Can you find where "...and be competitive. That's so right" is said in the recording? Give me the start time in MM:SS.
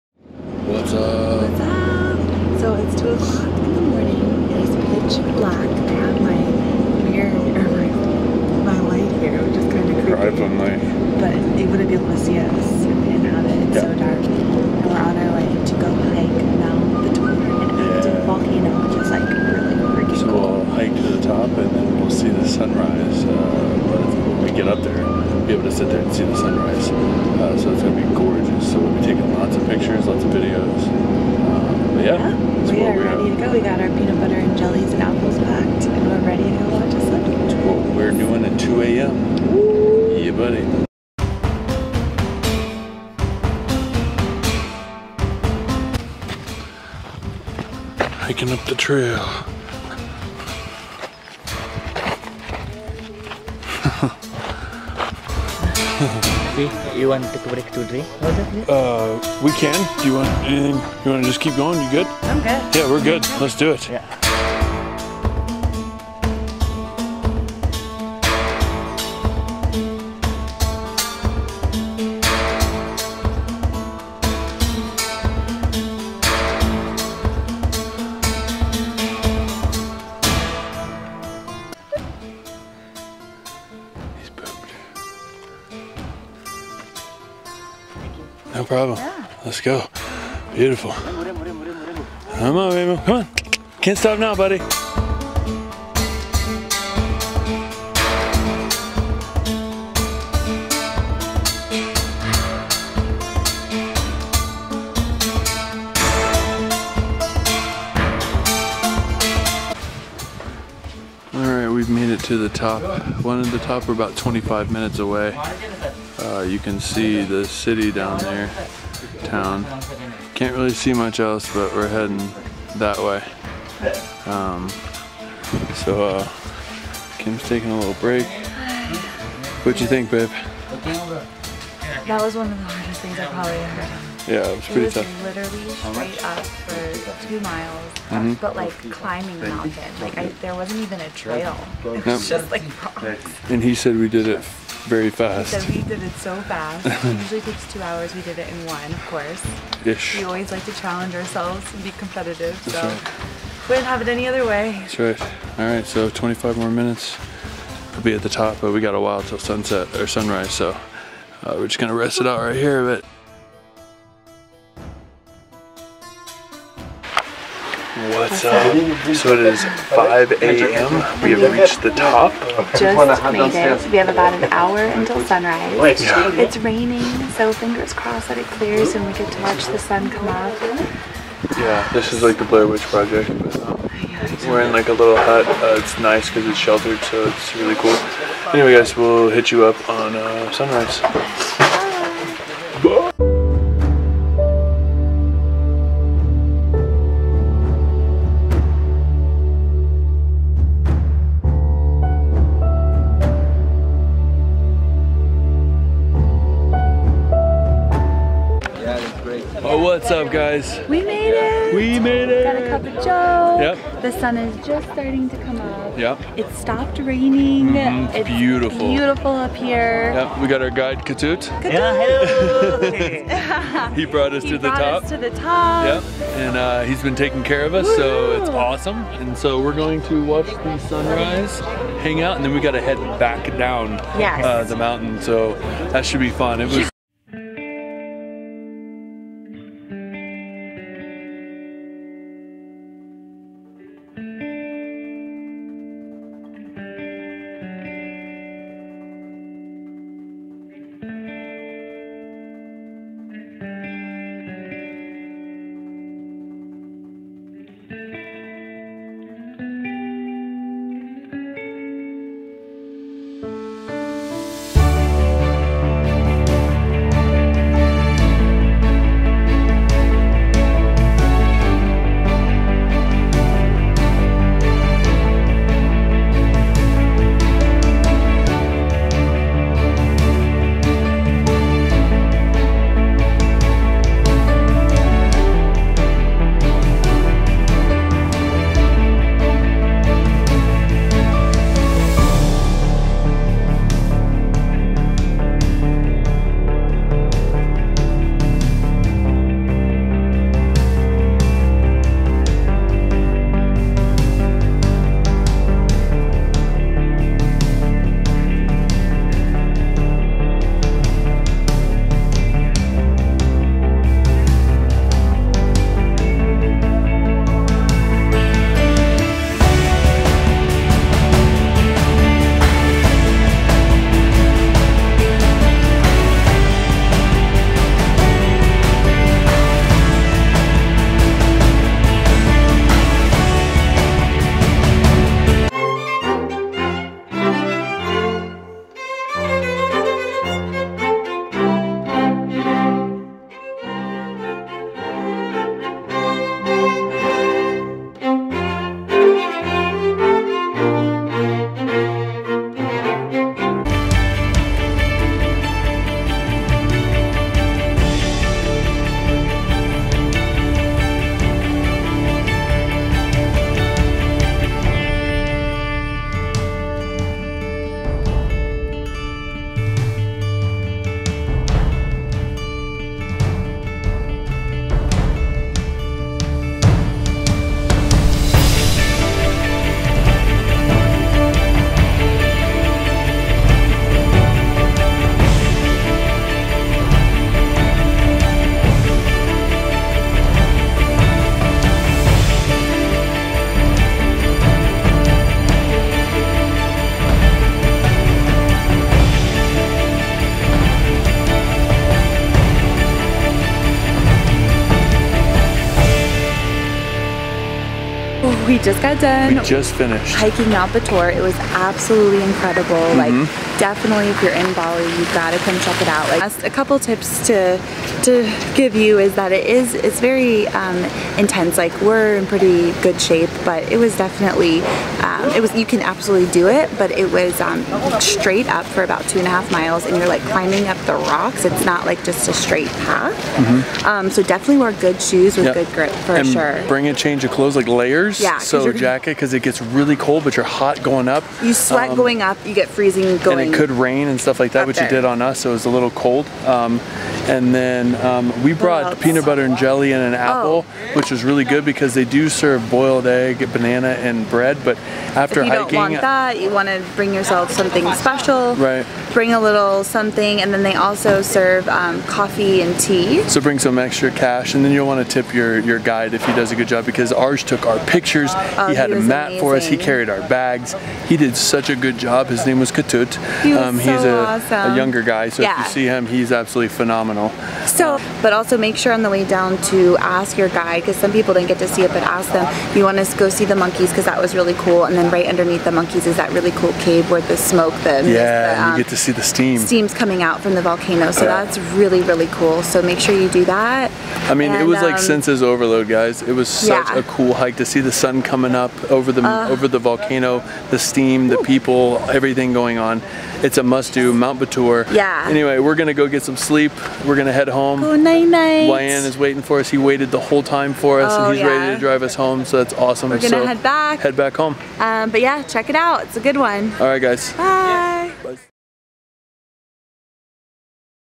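02:31.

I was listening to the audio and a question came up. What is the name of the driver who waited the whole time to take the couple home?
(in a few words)
Wayan.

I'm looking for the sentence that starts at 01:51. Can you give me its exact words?
All right, we've made it to the top.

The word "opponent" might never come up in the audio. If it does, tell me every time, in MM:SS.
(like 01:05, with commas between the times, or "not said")
not said.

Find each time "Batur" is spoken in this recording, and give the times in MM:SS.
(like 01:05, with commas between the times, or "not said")
06:50, 08:24.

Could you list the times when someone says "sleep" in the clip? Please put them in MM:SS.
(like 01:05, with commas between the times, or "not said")
00:36, 08:26.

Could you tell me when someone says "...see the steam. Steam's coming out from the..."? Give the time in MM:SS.
08:09.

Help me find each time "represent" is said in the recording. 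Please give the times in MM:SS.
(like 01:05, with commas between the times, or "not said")
not said.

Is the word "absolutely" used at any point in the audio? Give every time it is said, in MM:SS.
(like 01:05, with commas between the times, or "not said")
06:51, 07:06, 07:56.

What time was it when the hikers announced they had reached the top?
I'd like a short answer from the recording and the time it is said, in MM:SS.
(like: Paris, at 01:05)
5 a.m., at 02:49.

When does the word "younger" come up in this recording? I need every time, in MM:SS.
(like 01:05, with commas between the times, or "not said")
07:54.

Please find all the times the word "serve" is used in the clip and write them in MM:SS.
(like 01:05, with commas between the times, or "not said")
07:32, 07:41.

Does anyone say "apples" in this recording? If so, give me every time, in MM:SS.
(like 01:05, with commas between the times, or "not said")
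00:35, 07:30.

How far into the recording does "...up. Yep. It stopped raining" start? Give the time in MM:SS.
03:35.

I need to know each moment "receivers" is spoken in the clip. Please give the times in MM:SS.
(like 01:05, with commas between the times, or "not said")
not said.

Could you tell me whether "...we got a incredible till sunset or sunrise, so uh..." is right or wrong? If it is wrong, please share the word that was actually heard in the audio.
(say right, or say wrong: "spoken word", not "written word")
wrong: "while", not "incredible".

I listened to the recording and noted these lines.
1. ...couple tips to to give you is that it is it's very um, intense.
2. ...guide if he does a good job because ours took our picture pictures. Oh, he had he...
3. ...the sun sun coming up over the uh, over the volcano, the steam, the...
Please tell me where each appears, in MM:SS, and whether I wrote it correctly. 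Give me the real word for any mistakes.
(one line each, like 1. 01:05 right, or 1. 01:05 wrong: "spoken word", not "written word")
1. 06:56 right
2. 07:45 right
3. 08:18 right.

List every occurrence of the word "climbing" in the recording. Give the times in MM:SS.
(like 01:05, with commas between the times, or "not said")
02:18, 07:10.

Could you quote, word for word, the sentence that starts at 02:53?
We have about an hour until sunrise.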